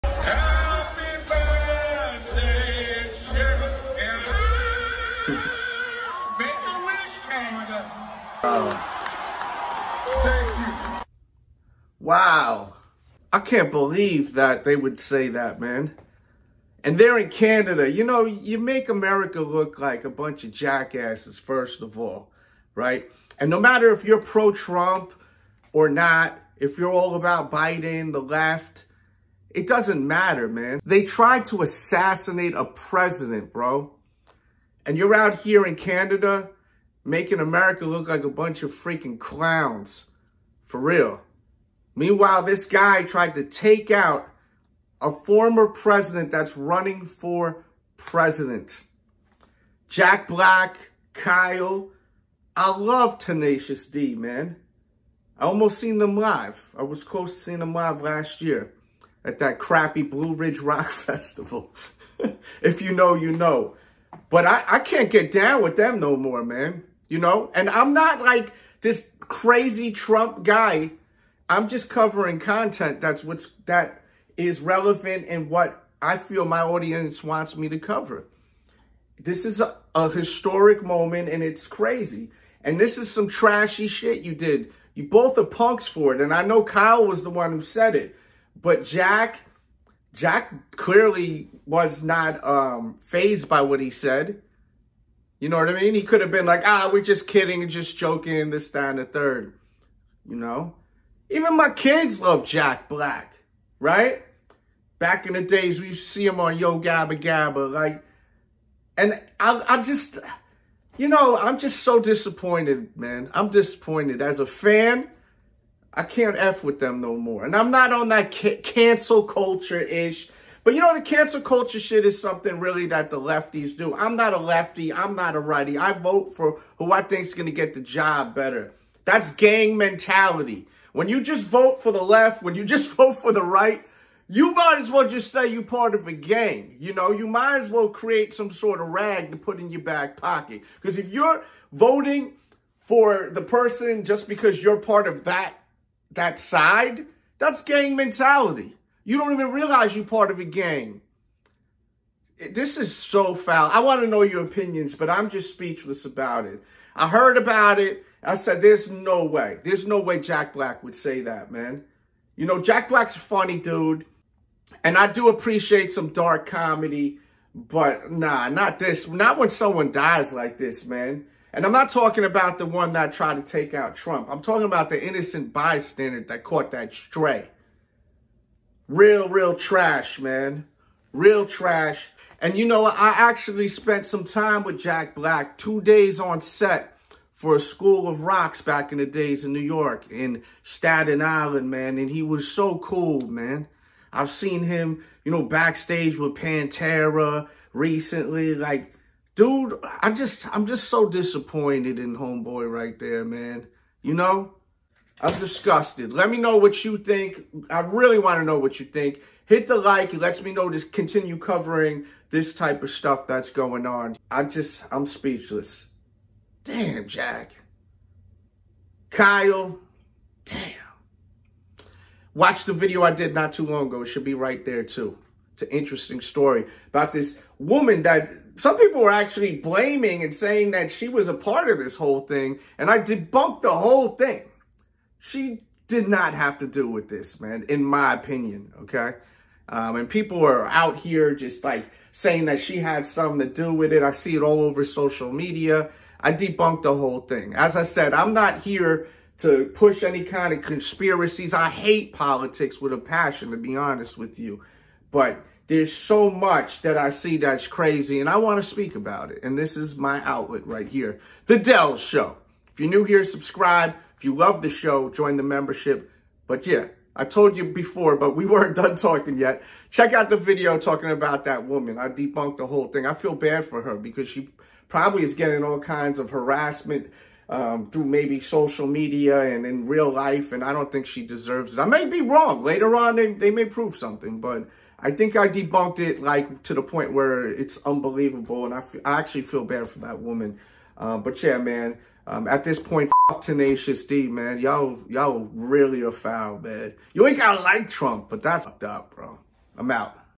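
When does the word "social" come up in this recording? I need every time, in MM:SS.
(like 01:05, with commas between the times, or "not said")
04:04, 04:38.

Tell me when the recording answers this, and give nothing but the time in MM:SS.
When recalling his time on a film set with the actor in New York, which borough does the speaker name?
03:10.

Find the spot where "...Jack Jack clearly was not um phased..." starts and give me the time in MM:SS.
01:28.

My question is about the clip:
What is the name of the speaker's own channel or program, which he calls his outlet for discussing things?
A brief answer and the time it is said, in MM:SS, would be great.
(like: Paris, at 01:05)
The Delz Show, at 04:21.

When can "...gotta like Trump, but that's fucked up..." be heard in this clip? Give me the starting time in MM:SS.
04:57.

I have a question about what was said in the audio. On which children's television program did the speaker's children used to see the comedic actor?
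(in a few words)
Yo Gabba Gabba.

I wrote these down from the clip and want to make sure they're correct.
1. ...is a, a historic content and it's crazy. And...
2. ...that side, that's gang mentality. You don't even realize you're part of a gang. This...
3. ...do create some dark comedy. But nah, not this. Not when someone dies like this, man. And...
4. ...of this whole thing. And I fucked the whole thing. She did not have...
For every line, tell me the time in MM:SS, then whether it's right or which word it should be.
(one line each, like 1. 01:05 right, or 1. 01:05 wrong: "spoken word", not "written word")
1. 01:19 wrong: "moment", not "content"
2. 02:26 right
3. 02:45 wrong: "appreciate", not "create"
4. 03:51 wrong: "debunked", not "fucked".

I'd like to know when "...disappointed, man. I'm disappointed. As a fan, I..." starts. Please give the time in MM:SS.
01:52.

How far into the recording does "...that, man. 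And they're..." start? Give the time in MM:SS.
00:15.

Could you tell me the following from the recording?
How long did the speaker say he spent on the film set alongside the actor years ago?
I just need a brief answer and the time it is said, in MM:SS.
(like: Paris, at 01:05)
2 days, at 03:05.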